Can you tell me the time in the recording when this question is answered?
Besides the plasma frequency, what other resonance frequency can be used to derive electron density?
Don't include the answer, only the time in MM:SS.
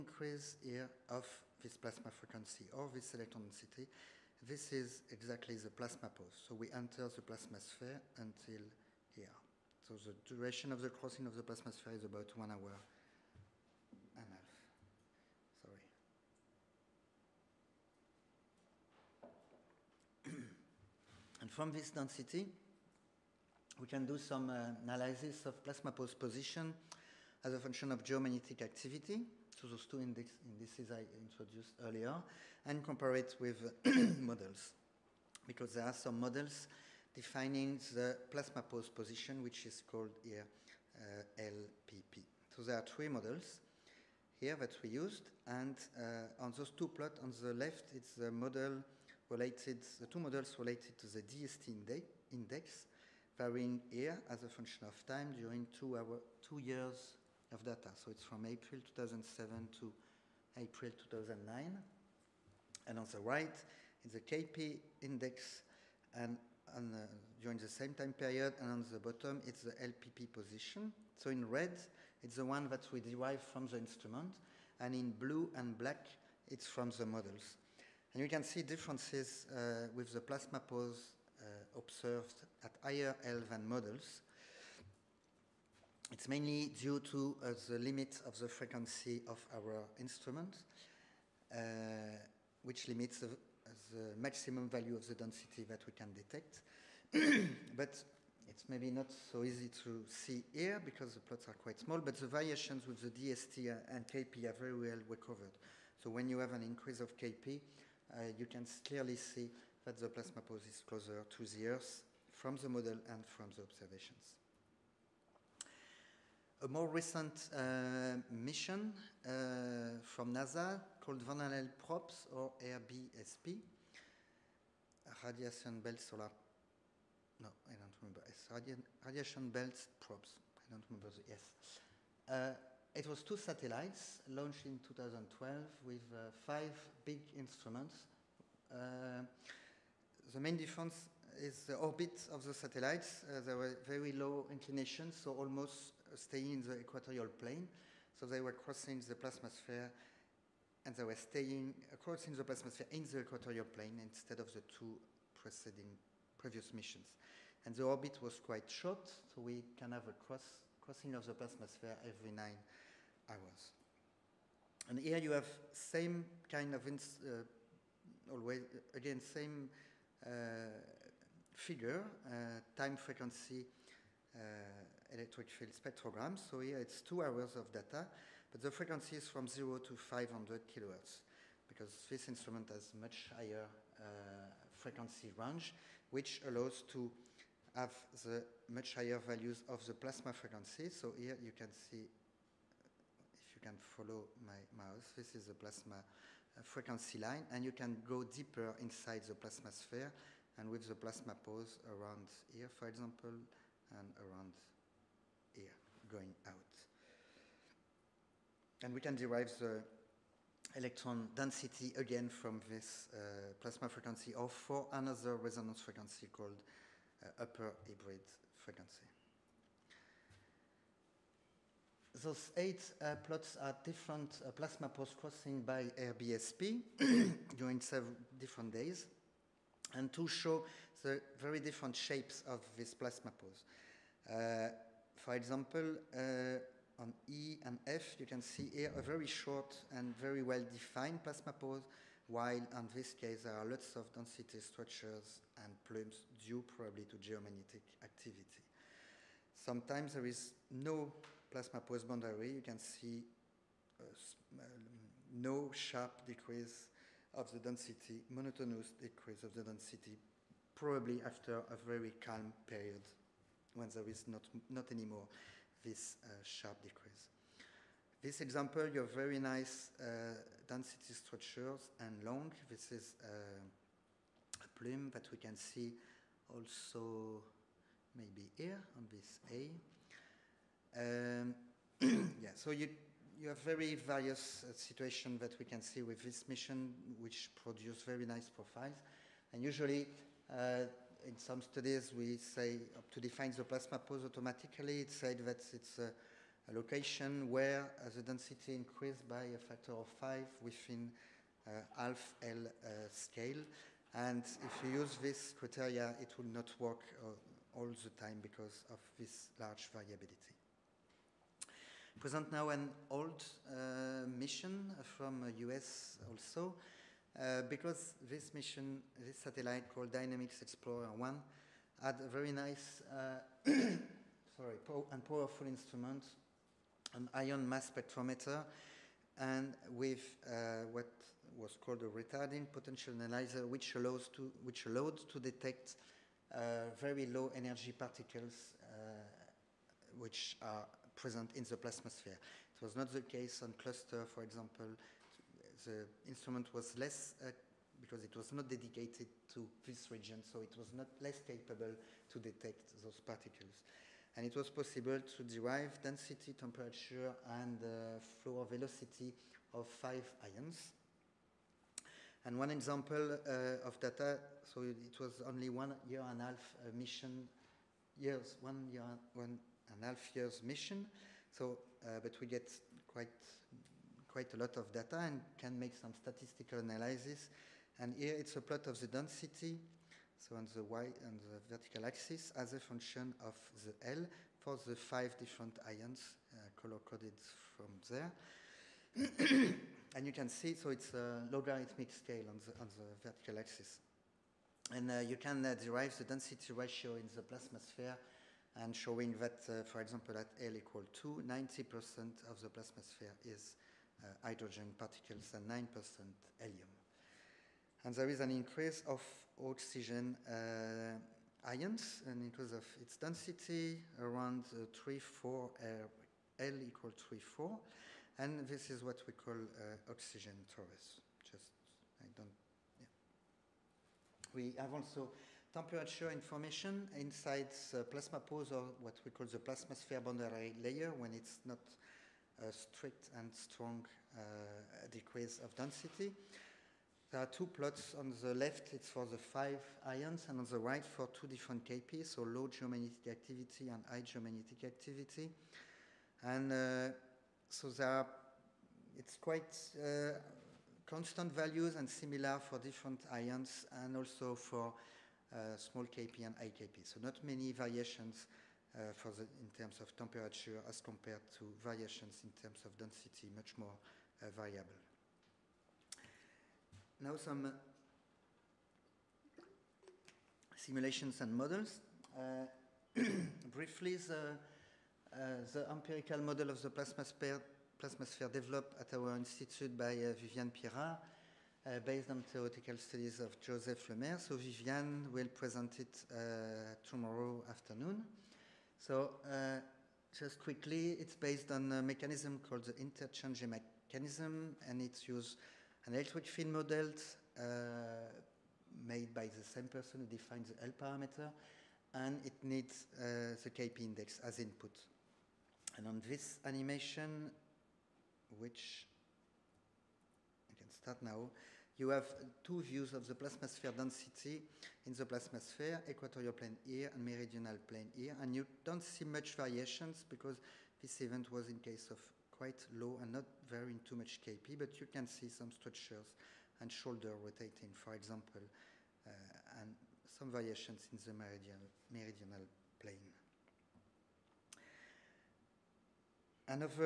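03:37.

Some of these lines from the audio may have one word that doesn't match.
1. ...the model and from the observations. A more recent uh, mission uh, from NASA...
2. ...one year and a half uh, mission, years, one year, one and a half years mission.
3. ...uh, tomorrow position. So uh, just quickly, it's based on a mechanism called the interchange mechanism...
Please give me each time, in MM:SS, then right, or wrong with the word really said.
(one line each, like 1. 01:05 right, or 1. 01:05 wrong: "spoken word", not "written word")
1. 01:52 right
2. 06:05 right
3. 08:06 wrong: "afternoon", not "position".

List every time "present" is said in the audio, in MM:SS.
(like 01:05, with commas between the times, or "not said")
05:12, 05:41, 08:05.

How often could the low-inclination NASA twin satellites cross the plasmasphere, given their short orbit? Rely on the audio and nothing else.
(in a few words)
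Every 9 hours.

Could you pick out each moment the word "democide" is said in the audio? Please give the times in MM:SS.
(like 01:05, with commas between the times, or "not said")
not said.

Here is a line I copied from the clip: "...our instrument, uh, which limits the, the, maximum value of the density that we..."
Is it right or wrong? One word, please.
right.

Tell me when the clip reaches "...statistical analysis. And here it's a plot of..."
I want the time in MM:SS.
06:16.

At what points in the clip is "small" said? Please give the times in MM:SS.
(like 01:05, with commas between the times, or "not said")
01:41, 07:35.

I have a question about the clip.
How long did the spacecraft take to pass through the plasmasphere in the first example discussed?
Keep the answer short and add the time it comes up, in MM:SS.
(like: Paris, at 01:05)
1.5 hours, at 00:12.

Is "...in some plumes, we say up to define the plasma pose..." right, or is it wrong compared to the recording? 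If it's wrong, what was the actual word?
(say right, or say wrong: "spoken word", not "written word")
wrong: "studies", not "plumes".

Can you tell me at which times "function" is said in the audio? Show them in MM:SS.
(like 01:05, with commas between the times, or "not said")
00:27, 00:54, 06:22.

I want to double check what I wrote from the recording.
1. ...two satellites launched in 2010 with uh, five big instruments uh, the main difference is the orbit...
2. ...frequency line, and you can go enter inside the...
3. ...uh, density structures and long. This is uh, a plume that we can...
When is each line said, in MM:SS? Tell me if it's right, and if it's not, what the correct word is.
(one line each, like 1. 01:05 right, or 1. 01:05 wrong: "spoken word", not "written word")
1. 02:13 wrong: "2012", not "2010"
2. 03:16 wrong: "deeper", not "enter"
3. 04:29 right.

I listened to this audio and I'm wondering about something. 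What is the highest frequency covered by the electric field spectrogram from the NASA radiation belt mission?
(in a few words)
500 kilohertz.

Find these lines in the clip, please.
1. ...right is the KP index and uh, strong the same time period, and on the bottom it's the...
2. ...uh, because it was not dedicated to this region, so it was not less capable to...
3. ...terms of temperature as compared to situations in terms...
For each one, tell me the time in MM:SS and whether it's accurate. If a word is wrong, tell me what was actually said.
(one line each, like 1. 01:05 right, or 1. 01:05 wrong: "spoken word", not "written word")
1. 01:03 wrong: "during", not "strong"
2. 05:47 right
3. 07:39 wrong: "variations", not "situations".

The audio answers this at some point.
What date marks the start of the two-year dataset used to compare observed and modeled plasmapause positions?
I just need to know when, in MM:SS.
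00:58.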